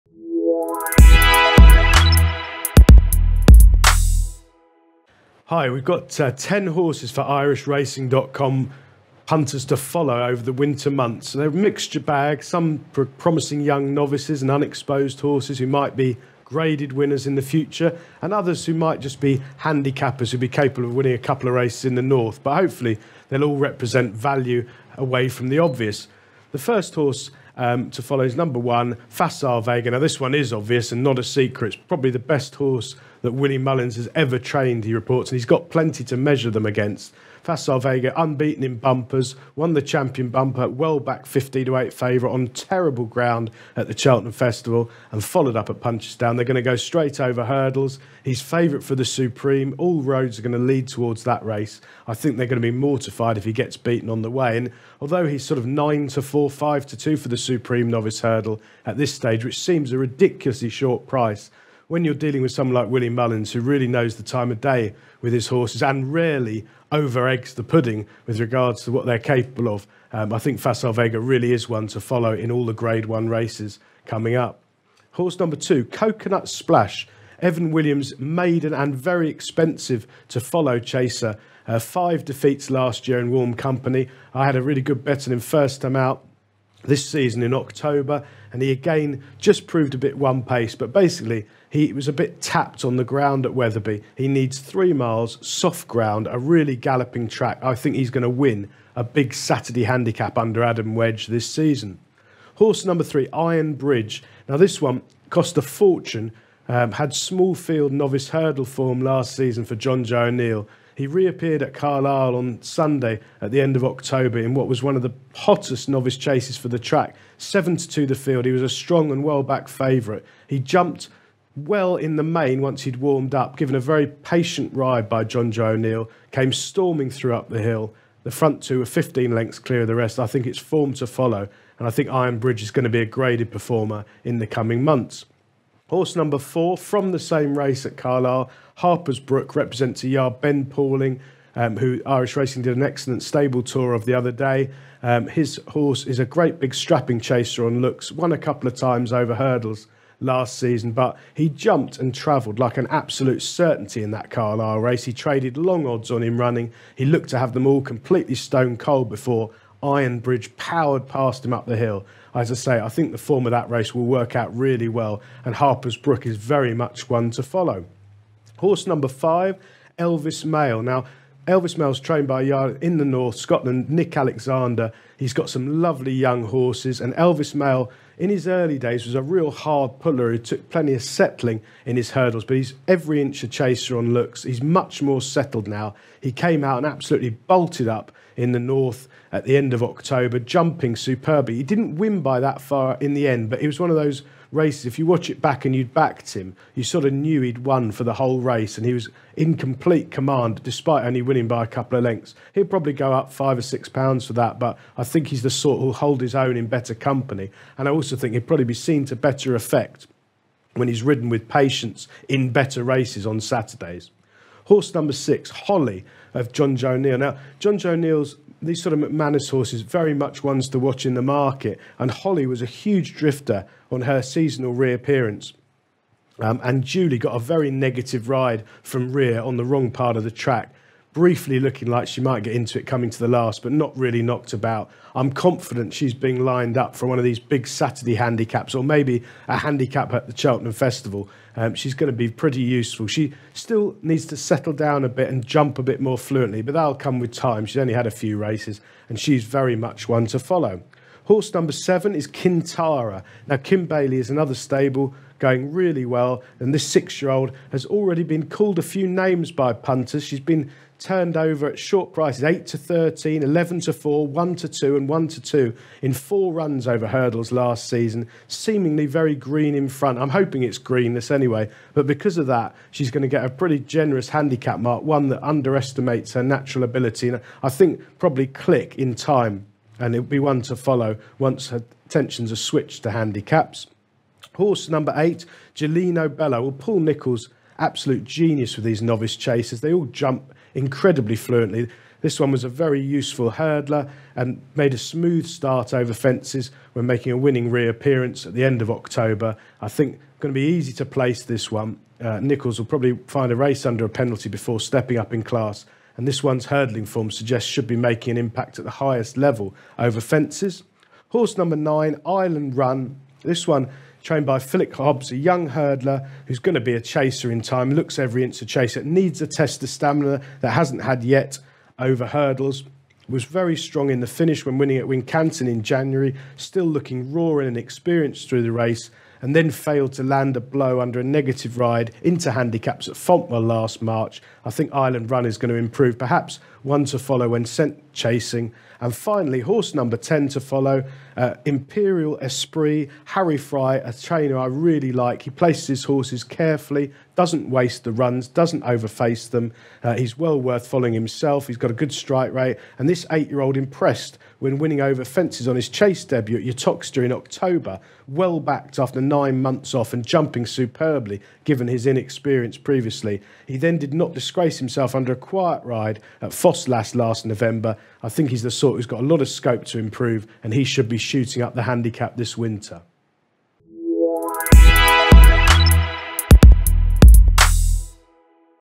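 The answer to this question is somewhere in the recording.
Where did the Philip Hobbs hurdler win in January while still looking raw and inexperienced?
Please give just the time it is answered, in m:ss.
5:25.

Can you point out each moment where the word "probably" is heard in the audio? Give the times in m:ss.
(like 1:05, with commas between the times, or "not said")
0:31, 3:22, 3:28, 4:38, 5:02.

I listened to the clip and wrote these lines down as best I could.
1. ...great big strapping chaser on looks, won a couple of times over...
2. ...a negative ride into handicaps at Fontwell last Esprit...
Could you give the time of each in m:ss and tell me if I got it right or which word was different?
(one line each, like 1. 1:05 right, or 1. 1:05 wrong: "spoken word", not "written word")
1. 2:26 right
2. 5:31 wrong: "March", not "Esprit".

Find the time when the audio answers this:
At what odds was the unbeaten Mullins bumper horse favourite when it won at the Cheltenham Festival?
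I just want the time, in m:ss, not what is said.
0:41.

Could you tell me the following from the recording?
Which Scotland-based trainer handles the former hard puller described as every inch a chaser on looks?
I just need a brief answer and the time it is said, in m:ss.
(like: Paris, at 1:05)
Nick Alexander, at 2:53.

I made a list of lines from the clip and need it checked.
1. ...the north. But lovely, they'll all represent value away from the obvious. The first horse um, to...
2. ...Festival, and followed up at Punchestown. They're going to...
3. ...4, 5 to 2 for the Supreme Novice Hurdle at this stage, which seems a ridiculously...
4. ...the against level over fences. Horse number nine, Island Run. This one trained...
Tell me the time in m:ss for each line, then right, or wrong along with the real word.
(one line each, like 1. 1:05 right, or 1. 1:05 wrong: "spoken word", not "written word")
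1. 0:21 wrong: "hopefully", not "lovely"
2. 0:44 right
3. 0:56 right
4. 5:08 wrong: "highest", not "against".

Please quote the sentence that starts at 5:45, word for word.
He places his horses carefully, doesn't waste the runs, doesn't overface them.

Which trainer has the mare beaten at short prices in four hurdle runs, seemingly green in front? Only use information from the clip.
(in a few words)
Kim Bailey.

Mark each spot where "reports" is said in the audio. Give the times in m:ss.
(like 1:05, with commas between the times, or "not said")
0:34.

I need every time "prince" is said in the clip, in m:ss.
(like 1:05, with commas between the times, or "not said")
not said.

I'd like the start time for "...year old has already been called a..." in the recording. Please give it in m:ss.
4:17.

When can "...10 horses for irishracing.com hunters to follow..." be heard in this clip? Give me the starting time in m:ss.
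0:06.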